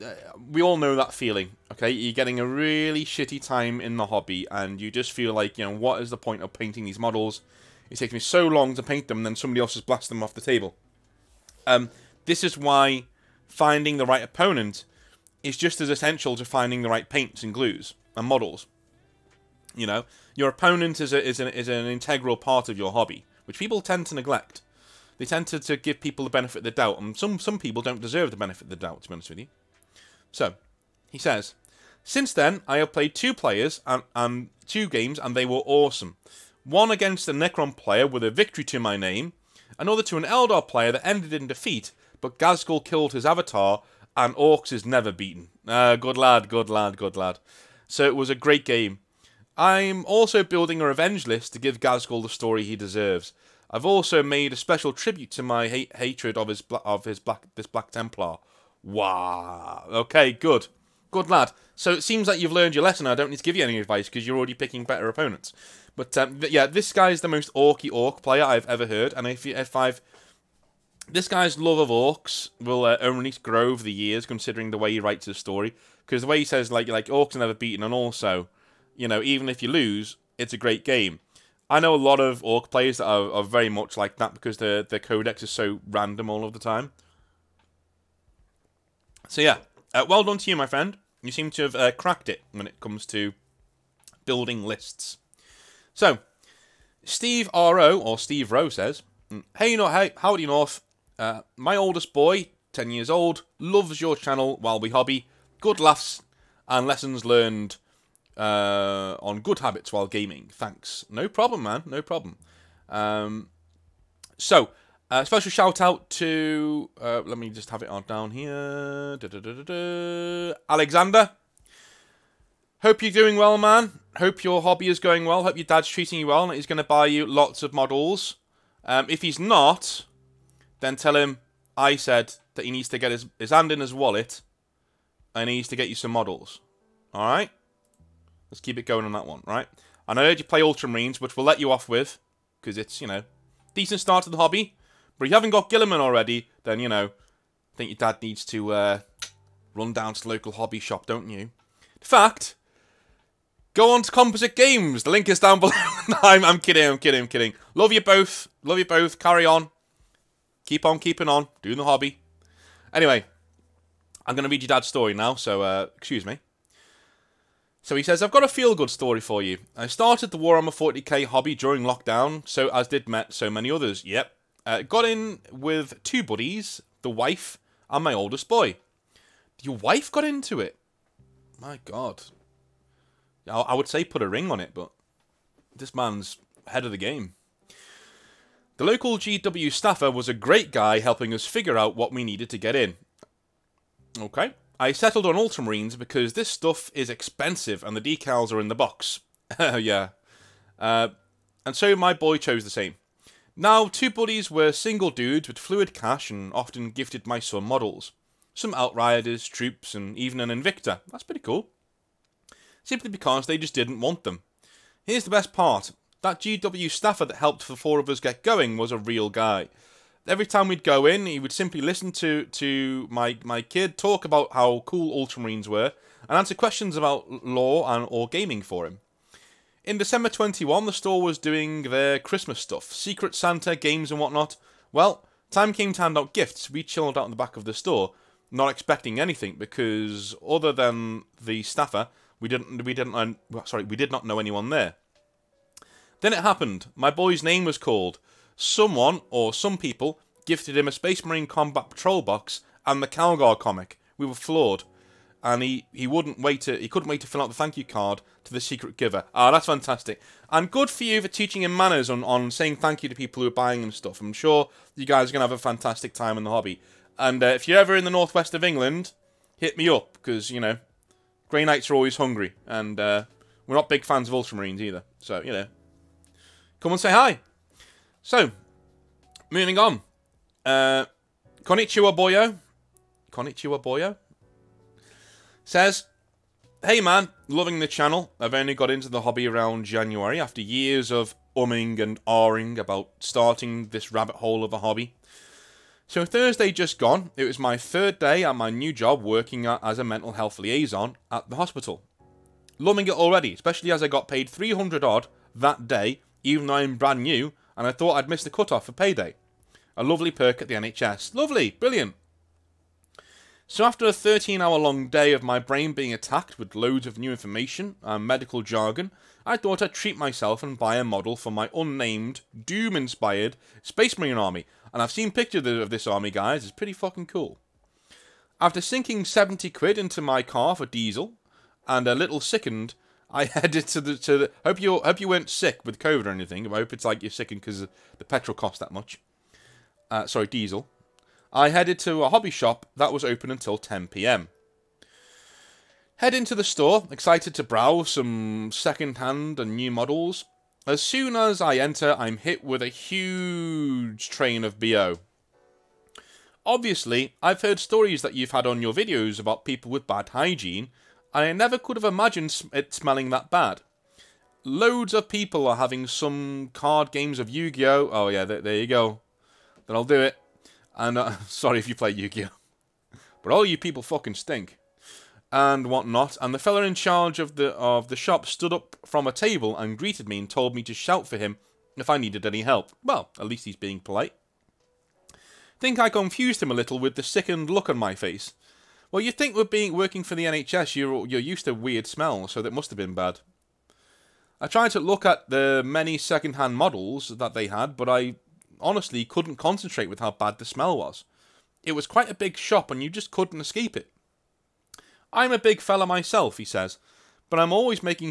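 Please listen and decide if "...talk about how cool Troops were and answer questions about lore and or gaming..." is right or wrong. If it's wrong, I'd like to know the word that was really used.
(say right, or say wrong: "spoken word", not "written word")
wrong: "Ultramarines", not "Troops".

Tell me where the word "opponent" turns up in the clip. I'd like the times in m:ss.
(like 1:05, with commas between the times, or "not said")
0:14, 0:20, 1:05.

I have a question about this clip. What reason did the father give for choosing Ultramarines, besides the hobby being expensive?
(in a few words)
Decals are in the box.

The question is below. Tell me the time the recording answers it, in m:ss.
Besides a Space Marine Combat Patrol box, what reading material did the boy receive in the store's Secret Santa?
4:13.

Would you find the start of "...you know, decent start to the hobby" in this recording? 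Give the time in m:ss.
2:23.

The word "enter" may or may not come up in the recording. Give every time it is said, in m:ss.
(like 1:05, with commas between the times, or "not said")
5:51.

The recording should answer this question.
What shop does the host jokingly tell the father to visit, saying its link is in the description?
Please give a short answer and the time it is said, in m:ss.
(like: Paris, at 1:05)
Composite Games, at 2:34.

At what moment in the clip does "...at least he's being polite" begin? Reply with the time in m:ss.
6:23.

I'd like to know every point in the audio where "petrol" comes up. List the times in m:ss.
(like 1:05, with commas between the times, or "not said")
5:38.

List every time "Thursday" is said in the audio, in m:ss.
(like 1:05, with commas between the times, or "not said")
4:56.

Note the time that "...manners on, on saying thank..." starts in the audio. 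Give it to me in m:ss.
4:21.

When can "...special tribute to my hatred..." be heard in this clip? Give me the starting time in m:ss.
0:54.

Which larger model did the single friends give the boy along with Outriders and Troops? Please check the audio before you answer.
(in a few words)
Invicta.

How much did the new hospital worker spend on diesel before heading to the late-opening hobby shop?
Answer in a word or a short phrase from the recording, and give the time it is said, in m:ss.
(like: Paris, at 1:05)
70 quid, at 5:29.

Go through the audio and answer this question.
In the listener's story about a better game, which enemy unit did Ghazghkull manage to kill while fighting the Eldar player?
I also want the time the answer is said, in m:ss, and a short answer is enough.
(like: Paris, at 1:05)
Avatar, at 0:43.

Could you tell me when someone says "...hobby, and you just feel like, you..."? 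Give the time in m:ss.
0:04.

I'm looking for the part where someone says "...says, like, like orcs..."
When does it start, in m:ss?
1:16.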